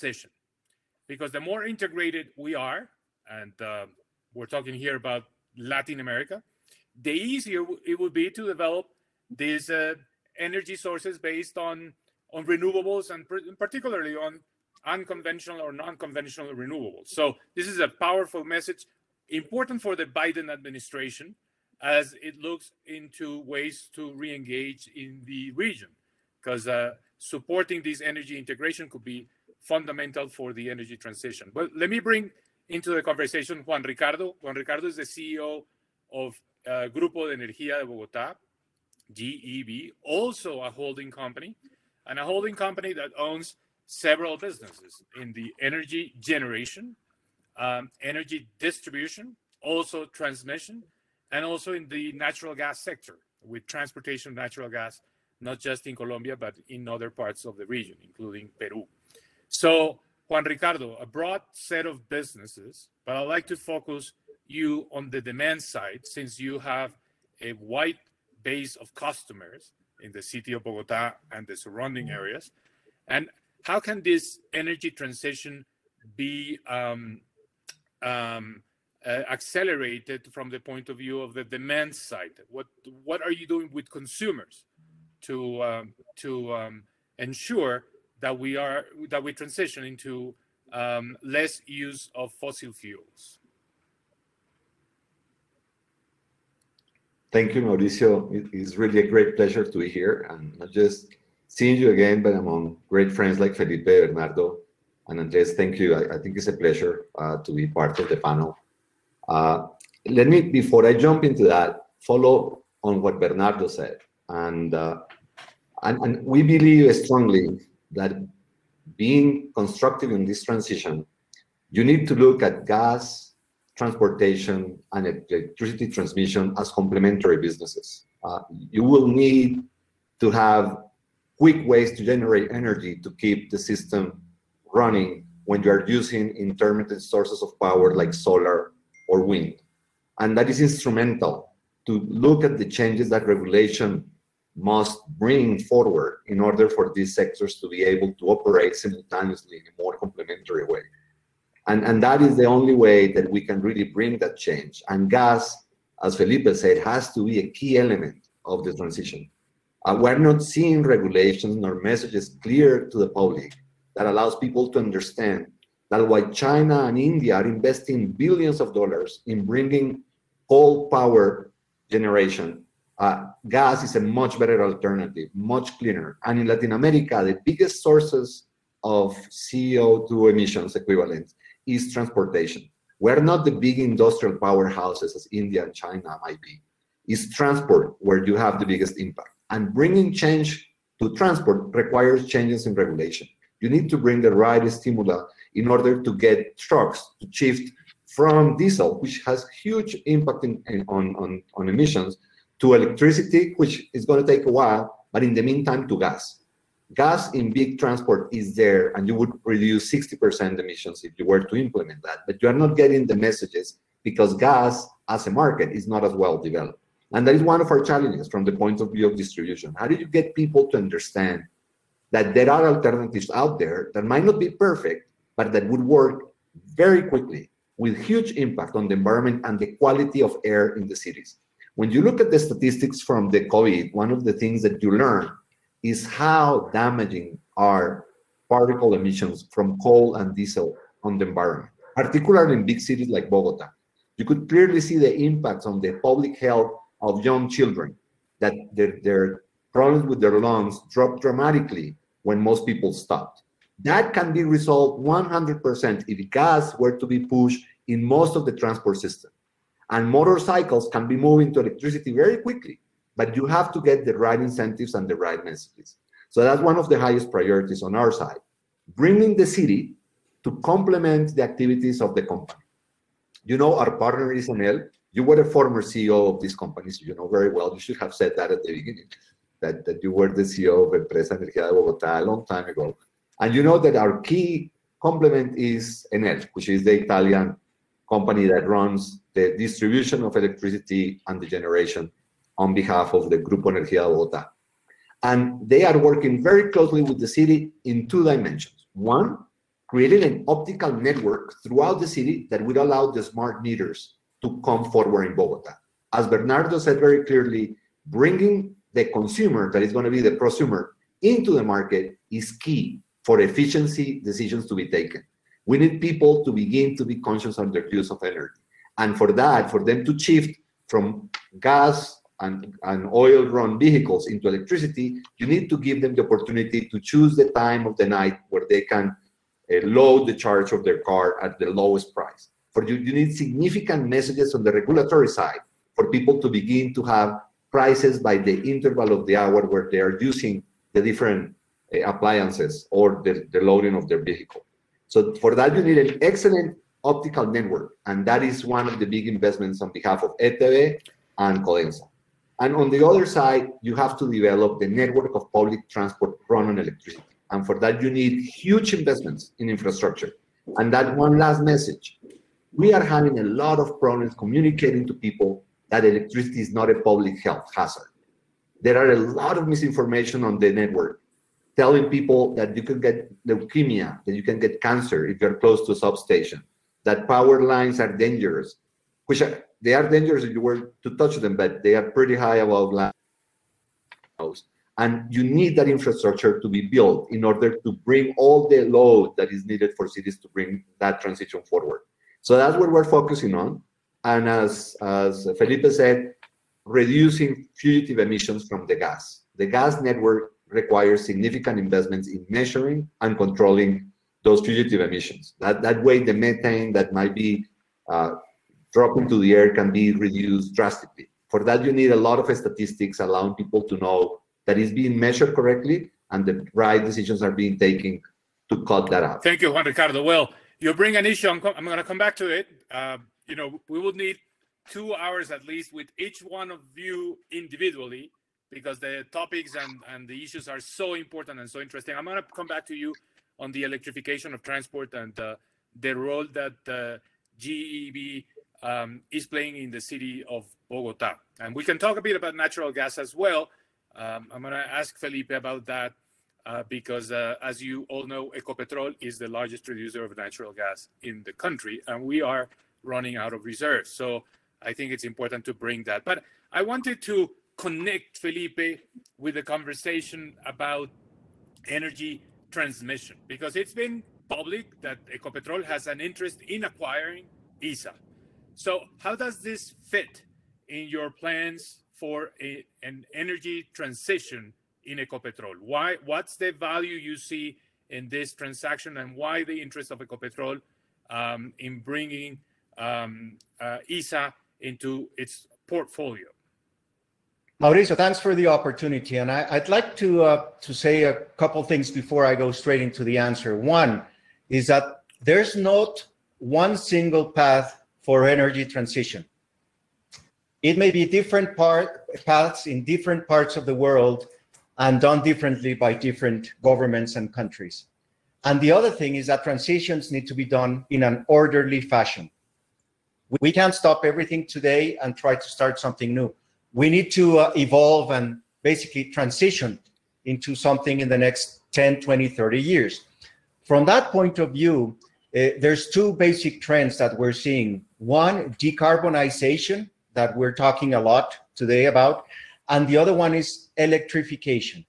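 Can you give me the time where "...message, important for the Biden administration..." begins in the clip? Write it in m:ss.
0:18.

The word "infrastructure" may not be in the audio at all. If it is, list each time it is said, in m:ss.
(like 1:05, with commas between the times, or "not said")
5:59, 6:25.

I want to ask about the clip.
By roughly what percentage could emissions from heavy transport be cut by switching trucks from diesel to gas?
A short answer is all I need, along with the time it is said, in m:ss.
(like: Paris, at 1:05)
60%, at 3:29.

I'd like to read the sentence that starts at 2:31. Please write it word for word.
And, and that is the only way that we can really bring that change.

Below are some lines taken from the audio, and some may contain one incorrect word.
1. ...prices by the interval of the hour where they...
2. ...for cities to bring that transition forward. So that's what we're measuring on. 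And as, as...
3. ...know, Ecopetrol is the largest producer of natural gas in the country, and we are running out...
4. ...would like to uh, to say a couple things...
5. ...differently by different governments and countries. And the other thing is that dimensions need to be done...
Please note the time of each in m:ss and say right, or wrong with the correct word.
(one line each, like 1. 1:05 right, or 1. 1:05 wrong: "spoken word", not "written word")
1. 5:37 right
2. 6:29 wrong: "focusing", not "measuring"
3. 7:28 right
4. 8:09 right
5. 8:25 wrong: "transitions", not "dimensions".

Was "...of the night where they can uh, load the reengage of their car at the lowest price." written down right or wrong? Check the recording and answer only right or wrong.
wrong.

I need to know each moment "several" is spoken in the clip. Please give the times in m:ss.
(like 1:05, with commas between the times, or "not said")
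0:43.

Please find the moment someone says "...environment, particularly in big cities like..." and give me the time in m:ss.
4:01.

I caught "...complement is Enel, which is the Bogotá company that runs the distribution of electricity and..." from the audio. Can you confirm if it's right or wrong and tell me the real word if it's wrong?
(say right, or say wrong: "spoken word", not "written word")
wrong: "Italian", not "Bogotá".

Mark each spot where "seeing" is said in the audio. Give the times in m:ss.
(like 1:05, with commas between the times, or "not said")
1:41, 2:40, 8:47.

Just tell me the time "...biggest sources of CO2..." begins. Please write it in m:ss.
2:57.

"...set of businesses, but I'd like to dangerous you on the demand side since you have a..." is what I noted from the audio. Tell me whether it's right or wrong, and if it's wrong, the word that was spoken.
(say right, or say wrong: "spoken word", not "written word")
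wrong: "focus", not "dangerous".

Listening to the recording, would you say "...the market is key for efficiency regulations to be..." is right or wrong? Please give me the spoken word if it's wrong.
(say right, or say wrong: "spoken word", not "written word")
wrong: "decisions", not "regulations".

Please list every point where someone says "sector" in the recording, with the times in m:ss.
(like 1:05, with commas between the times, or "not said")
0:52, 2:27.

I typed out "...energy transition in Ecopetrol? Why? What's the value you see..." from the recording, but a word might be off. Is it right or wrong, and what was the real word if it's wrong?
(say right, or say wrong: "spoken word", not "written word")
right.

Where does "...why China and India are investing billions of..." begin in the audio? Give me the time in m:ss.
2:46.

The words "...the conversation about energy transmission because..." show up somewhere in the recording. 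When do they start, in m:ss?
7:39.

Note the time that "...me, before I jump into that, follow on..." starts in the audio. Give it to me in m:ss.
1:50.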